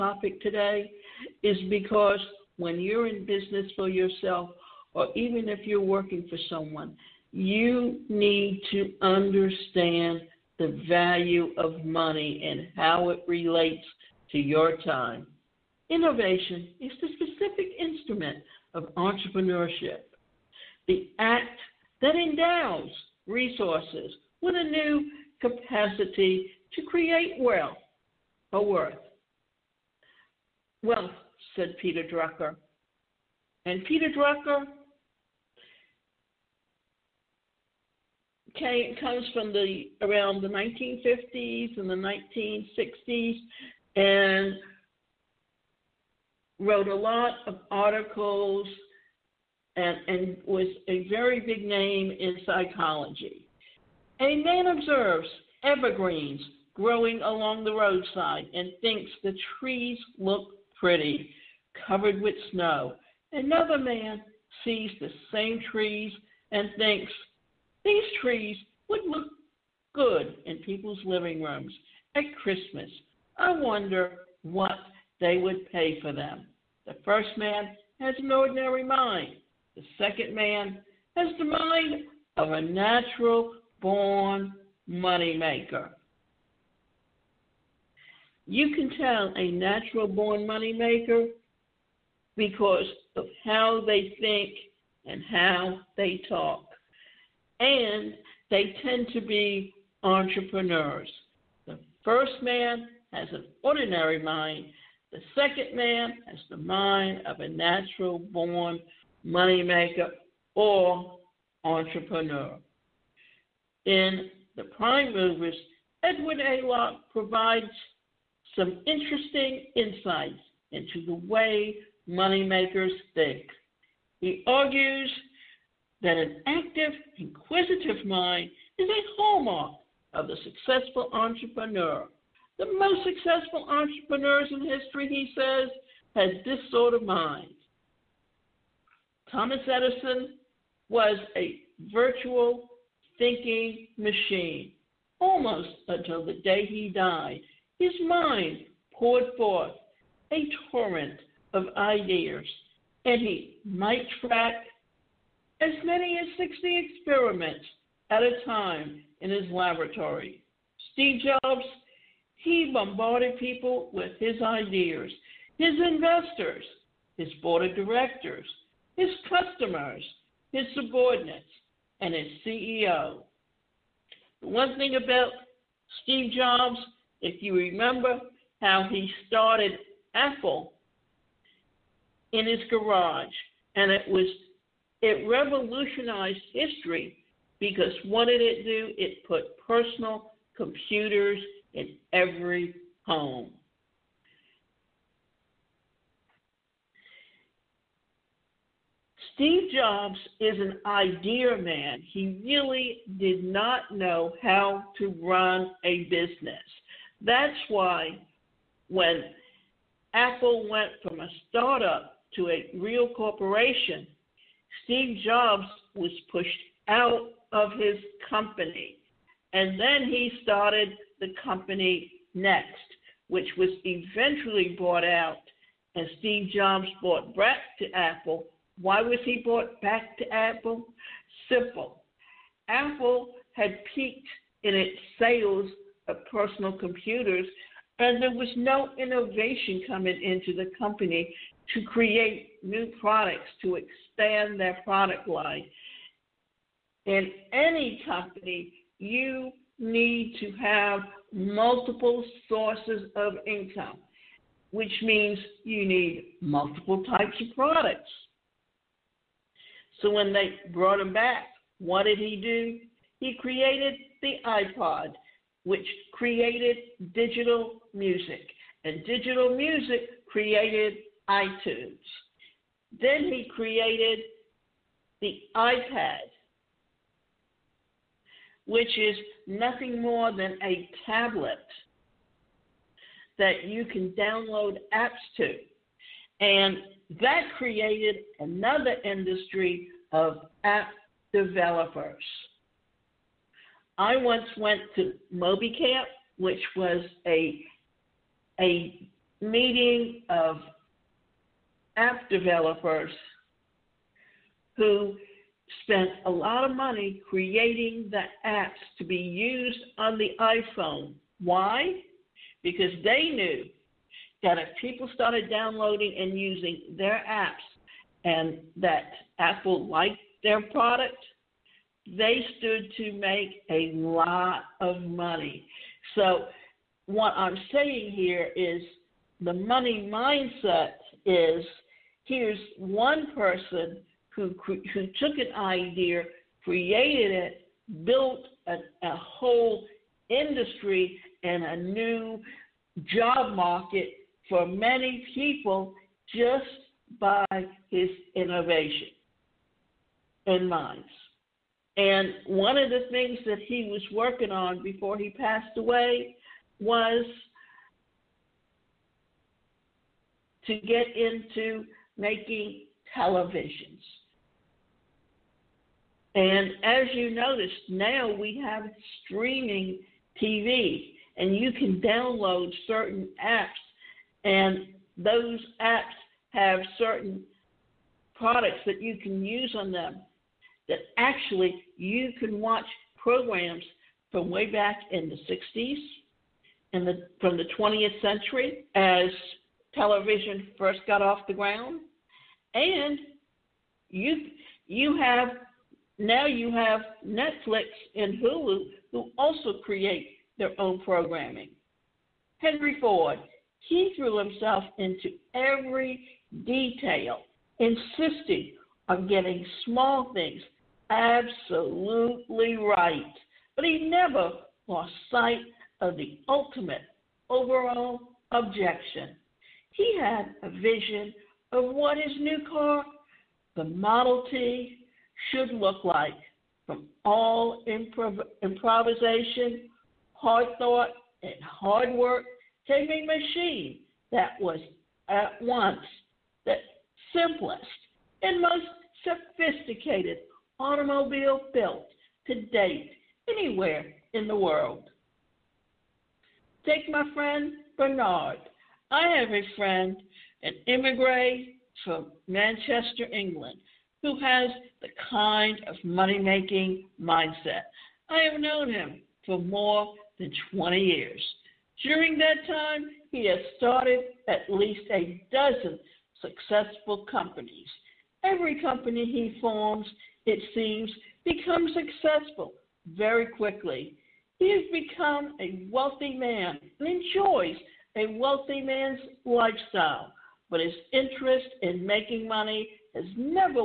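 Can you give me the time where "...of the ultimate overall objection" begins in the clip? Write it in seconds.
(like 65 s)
416 s.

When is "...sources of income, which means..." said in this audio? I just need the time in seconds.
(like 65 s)
252 s.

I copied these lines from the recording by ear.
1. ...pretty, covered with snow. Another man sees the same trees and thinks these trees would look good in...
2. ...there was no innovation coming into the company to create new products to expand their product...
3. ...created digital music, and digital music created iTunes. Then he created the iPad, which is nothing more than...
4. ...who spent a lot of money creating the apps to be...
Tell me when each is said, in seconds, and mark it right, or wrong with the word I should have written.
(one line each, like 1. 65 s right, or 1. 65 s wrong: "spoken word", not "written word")
1. 60 s right
2. 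238 s right
3. 266 s right
4. 304 s right.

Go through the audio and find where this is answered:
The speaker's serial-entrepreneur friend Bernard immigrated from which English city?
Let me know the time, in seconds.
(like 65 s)
452 s.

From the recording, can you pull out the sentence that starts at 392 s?
And you, you have now you have Netflix and Hulu who also create their own programming.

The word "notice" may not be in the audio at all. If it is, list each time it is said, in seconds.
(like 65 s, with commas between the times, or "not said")
367 s.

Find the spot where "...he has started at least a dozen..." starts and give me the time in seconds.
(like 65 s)
463 s.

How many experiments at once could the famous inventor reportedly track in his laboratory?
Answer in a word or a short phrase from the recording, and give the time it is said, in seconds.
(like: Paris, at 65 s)
60, at 156 s.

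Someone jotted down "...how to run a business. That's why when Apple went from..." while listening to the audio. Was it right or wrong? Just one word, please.
right.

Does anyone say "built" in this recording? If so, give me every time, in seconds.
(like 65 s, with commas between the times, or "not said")
338 s, 441 s.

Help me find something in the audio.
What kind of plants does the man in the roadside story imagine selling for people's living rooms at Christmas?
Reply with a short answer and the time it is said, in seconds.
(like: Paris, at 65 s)
evergreens, at 55 s.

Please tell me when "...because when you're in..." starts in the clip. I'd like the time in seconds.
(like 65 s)
1 s.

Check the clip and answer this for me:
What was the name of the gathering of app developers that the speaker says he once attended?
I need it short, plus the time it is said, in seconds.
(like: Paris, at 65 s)
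MobiCamp, at 295 s.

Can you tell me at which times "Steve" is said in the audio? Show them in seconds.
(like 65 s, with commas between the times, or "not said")
160 s, 176 s, 199 s, 214 s, 226 s.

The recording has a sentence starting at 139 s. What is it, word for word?
Thomas Edison was a virtual thinking machine almost until the day he died.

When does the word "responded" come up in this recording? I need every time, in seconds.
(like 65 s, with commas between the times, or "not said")
not said.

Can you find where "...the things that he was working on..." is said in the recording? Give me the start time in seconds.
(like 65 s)
352 s.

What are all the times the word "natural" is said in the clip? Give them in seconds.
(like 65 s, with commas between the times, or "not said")
82 s, 89 s, 107 s.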